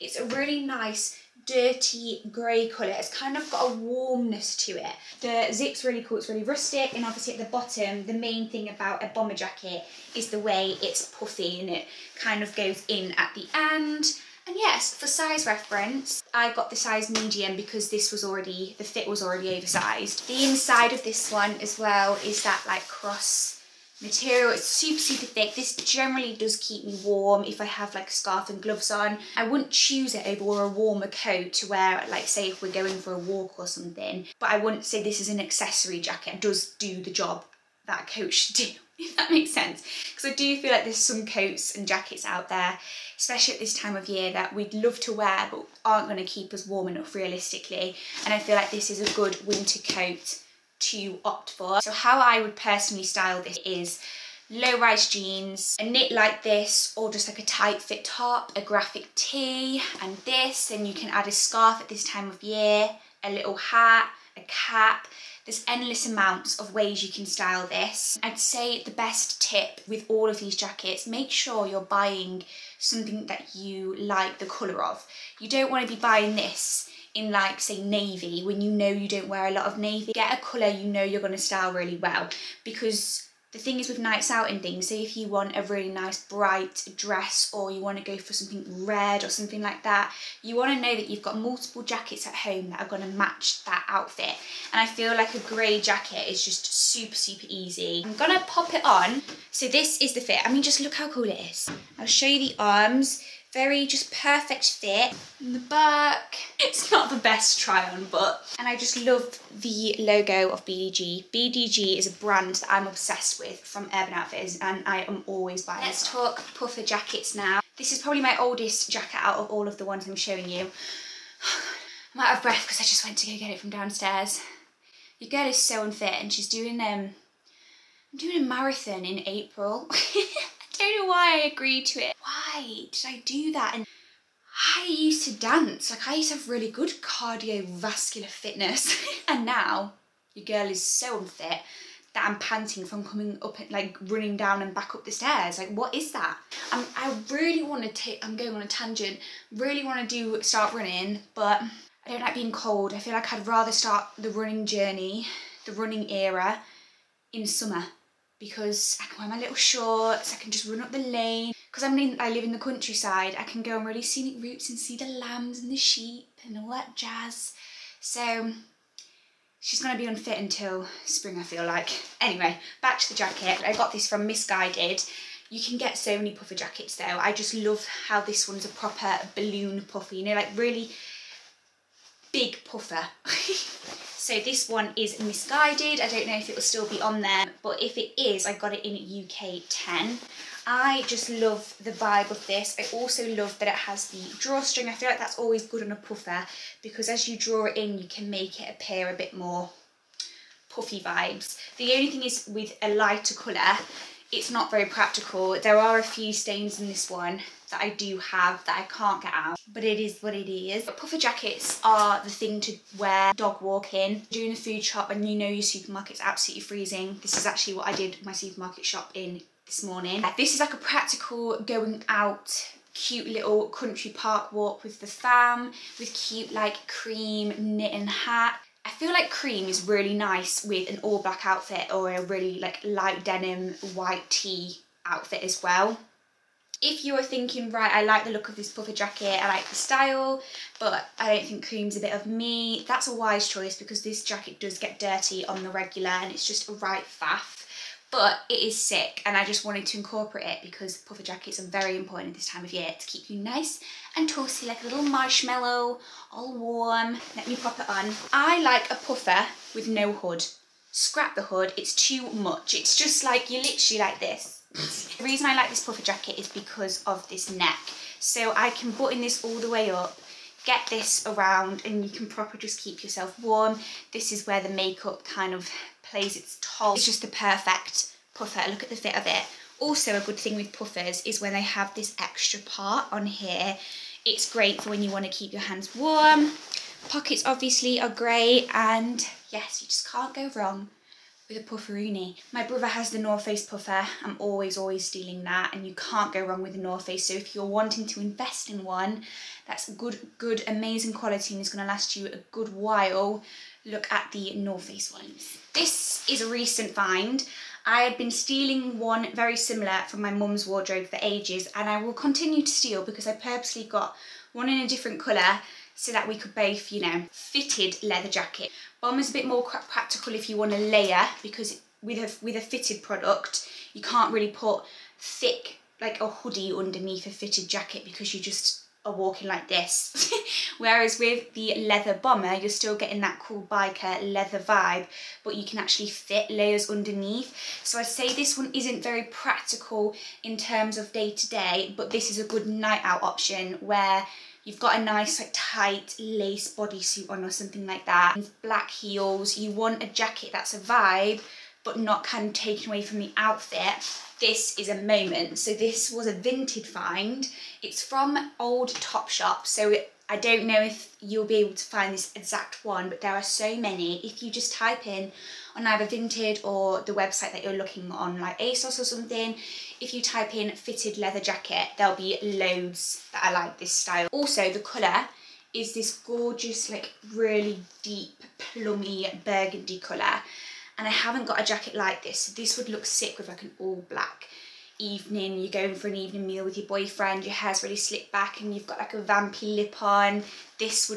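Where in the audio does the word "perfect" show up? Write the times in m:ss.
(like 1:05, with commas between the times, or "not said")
1:44, 4:37.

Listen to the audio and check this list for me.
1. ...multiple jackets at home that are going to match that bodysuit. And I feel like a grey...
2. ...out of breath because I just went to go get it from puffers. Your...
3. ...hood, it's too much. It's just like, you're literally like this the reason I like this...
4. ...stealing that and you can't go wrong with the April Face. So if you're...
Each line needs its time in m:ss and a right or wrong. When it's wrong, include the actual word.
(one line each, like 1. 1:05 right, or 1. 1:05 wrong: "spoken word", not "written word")
1. 1:31 wrong: "outfit", not "bodysuit"
2. 2:02 wrong: "downstairs", not "puffers"
3. 4:21 right
4. 4:55 wrong: "North", not "April".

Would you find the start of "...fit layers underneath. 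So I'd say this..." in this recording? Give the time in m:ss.
5:36.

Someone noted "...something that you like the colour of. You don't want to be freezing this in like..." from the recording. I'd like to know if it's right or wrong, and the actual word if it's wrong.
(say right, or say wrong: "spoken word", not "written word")
wrong: "buying", not "freezing".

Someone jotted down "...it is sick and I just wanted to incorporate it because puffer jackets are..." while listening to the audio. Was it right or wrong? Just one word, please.
right.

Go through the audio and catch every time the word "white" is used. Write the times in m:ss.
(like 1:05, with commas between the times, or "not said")
3:53.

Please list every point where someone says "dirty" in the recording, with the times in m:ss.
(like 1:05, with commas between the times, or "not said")
0:01, 4:04.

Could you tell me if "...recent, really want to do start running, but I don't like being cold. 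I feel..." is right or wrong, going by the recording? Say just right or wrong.
wrong.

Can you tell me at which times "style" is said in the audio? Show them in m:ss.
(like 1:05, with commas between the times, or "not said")
0:53, 1:07, 1:21, 3:59, 6:13.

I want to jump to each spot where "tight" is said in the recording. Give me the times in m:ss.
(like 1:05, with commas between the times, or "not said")
0:57, 5:45.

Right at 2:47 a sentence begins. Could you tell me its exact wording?
So she's going to be unfit until spring, I feel like.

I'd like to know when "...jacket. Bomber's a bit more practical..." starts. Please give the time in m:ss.
5:18.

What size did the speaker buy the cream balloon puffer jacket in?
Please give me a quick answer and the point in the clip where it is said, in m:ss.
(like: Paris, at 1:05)
UK 10, at 3:09.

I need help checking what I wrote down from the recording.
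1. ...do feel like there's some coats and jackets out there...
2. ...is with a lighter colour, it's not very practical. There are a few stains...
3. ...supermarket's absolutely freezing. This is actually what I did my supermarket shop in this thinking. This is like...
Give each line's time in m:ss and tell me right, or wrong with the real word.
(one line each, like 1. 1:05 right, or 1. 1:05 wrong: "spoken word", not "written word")
1. 0:40 right
2. 3:22 right
3. 3:35 wrong: "morning", not "thinking".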